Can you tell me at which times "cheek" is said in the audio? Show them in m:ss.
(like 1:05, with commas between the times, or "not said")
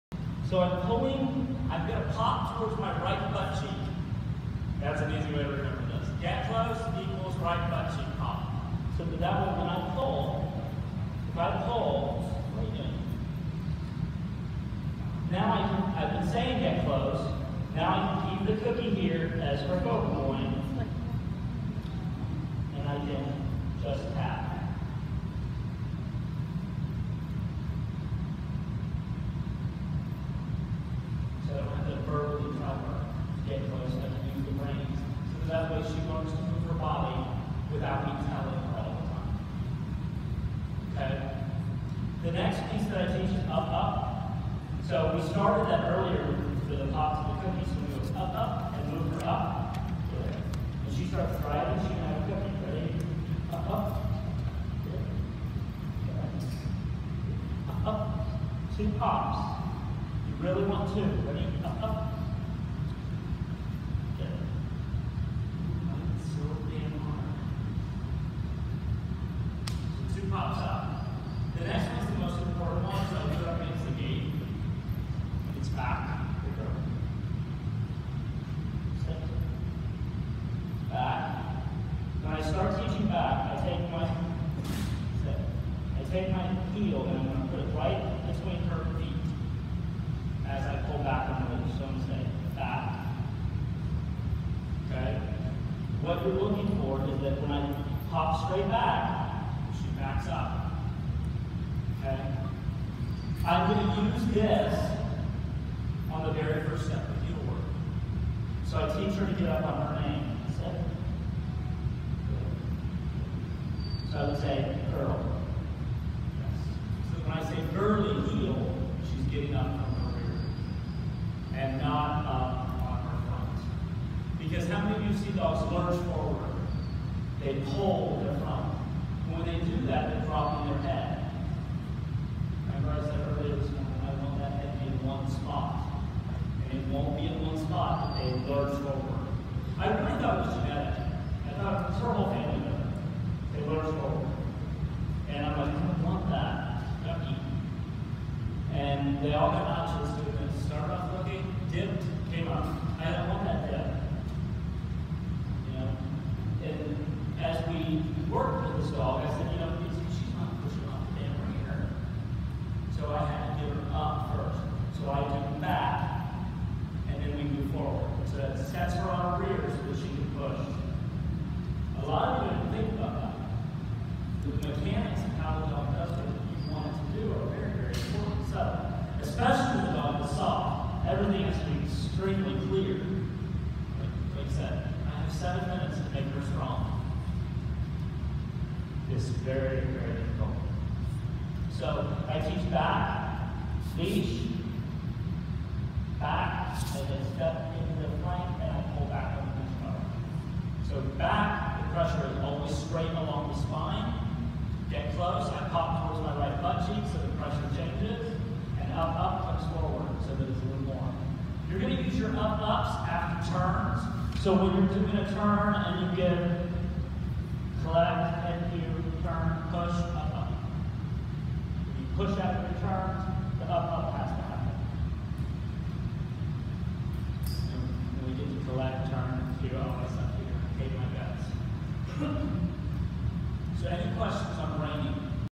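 0:03, 0:07, 3:26.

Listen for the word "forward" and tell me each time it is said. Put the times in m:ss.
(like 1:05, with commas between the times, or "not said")
2:06, 2:18, 2:23, 2:47, 3:29.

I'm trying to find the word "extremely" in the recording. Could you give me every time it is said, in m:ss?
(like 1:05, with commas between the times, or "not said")
3:01.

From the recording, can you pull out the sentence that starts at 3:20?
So back, the pressure is always straight along the spine.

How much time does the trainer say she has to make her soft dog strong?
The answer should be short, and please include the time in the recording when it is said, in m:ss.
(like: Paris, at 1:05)
7 minutes, at 3:05.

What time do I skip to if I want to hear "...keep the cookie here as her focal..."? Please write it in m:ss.
0:18.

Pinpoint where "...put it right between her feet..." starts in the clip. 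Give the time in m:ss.
1:27.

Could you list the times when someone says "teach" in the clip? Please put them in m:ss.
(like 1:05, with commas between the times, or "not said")
1:48, 3:12.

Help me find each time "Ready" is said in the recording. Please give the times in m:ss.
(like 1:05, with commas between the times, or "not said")
0:52, 1:01.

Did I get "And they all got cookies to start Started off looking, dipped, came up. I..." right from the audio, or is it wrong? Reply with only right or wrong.
wrong.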